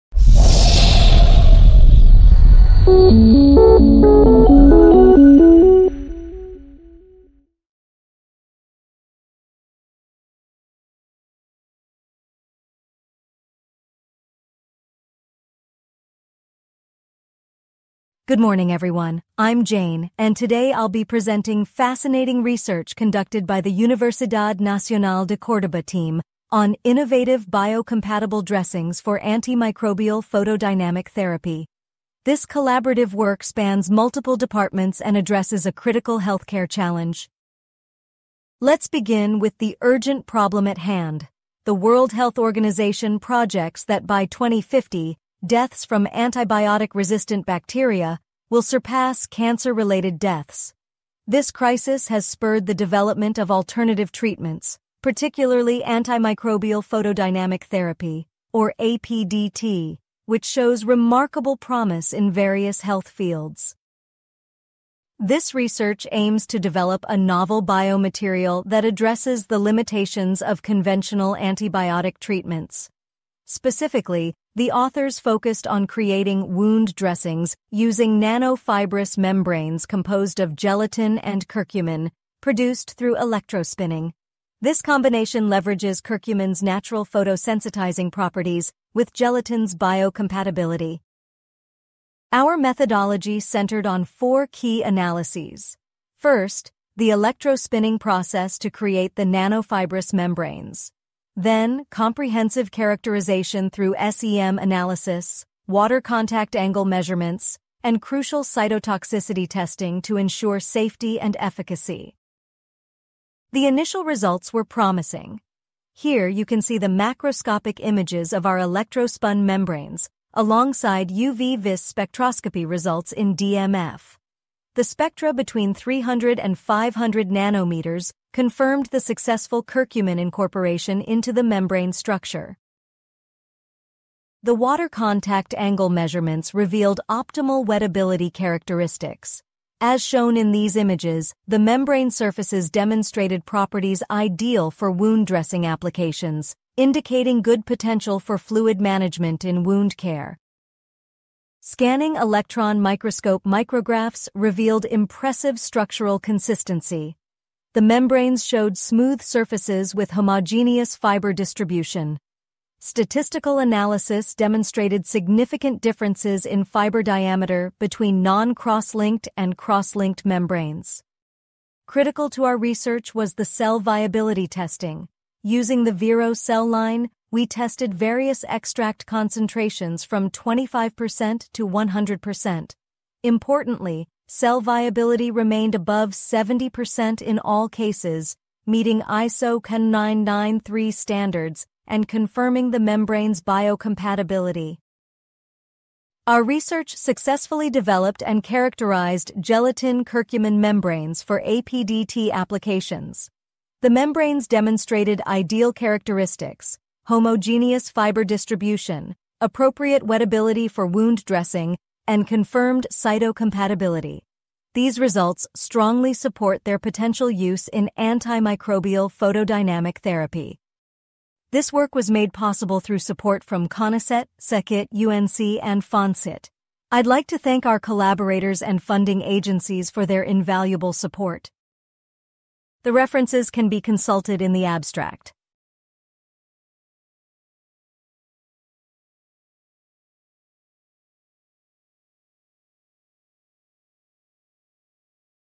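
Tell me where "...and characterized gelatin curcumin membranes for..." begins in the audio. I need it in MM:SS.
03:18.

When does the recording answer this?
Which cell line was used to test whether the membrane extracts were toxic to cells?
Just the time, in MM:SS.
02:55.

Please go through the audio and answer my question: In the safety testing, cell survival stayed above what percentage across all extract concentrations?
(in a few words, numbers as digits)
70%.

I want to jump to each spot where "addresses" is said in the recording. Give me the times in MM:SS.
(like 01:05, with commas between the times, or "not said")
00:35, 01:08.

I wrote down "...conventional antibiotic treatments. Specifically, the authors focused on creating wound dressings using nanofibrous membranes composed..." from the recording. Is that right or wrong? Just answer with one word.
right.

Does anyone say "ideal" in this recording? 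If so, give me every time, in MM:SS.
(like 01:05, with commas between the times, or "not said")
02:24, 03:25.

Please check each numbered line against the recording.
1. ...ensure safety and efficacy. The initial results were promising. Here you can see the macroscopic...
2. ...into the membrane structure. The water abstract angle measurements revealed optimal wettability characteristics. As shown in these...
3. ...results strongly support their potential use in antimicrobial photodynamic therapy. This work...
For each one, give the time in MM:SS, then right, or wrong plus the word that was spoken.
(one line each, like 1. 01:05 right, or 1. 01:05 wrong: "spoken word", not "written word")
1. 01:50 right
2. 02:11 wrong: "contact", not "abstract"
3. 03:34 right.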